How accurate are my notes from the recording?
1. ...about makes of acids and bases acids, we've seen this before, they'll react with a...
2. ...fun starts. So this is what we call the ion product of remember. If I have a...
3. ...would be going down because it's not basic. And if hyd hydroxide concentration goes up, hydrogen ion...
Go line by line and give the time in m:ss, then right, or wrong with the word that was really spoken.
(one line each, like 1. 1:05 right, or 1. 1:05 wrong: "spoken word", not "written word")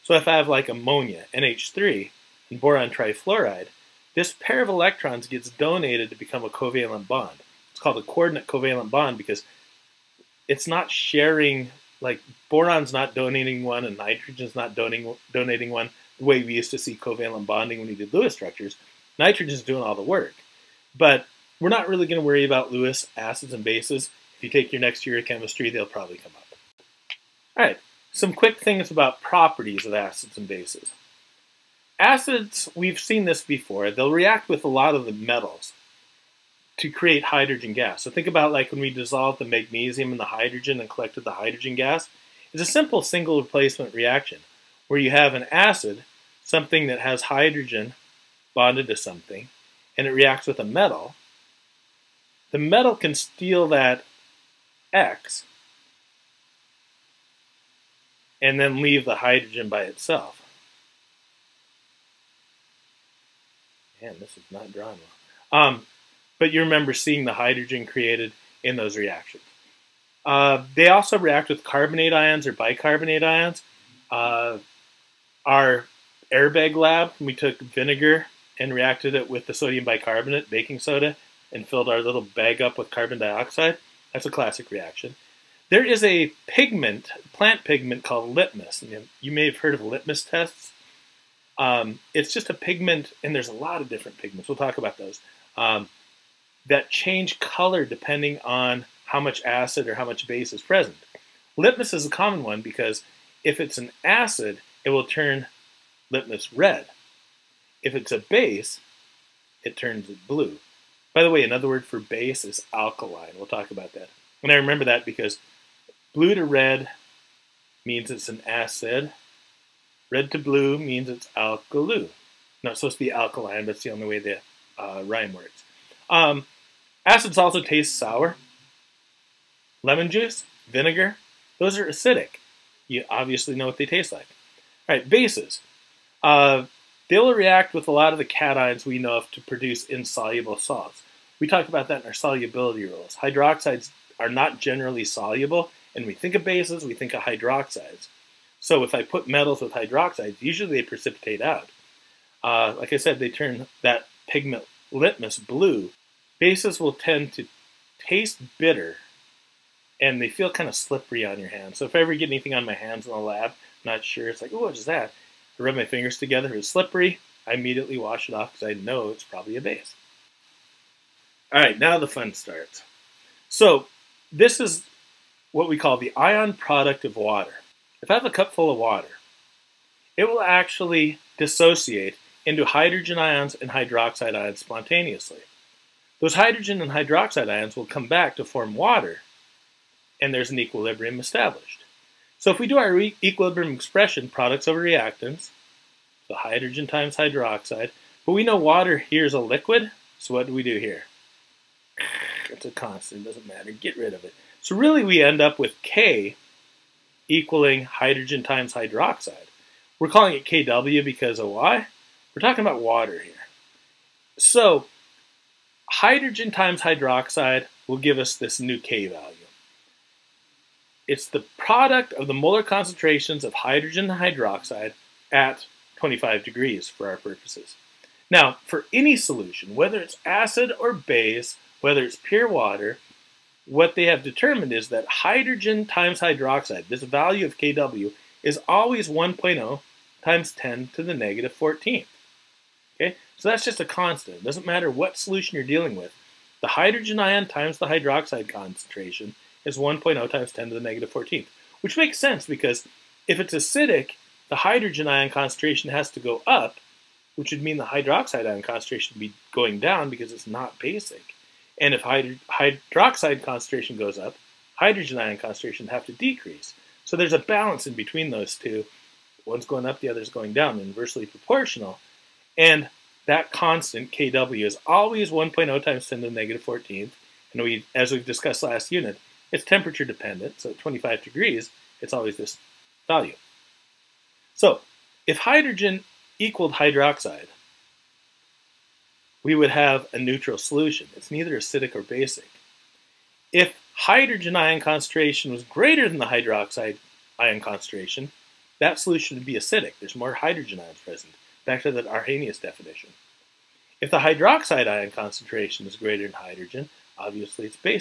1. 0:28 wrong: "properties", not "makes"
2. 2:52 wrong: "water", not "remember"
3. 4:19 right.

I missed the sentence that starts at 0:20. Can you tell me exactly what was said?
But we're not really going to worry about Lewis acids and bases.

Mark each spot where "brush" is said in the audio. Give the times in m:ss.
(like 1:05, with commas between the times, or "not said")
not said.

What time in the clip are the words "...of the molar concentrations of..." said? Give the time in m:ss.
3:42.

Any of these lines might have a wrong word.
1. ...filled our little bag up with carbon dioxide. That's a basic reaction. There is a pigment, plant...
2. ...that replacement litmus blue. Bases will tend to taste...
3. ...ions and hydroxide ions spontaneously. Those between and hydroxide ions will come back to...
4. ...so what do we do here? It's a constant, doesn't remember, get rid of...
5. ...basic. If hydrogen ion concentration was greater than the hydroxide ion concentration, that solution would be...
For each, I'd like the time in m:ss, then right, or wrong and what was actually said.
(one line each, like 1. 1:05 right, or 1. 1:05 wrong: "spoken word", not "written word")
1. 1:21 wrong: "classic", not "basic"
2. 2:33 wrong: "pigment", not "replacement"
3. 3:03 wrong: "hydrogen", not "between"
4. 3:20 wrong: "matter", not "remember"
5. 4:52 right.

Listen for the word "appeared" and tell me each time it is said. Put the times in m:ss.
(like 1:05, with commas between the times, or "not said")
not said.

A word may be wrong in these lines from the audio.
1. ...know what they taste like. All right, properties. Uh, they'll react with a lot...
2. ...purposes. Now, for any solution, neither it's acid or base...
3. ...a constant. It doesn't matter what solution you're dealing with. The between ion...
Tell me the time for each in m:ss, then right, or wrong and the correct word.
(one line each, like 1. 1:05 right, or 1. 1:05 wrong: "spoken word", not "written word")
1. 2:13 wrong: "bases", not "properties"
2. 3:47 wrong: "whether", not "neither"
3. 4:03 wrong: "hydrogen", not "between".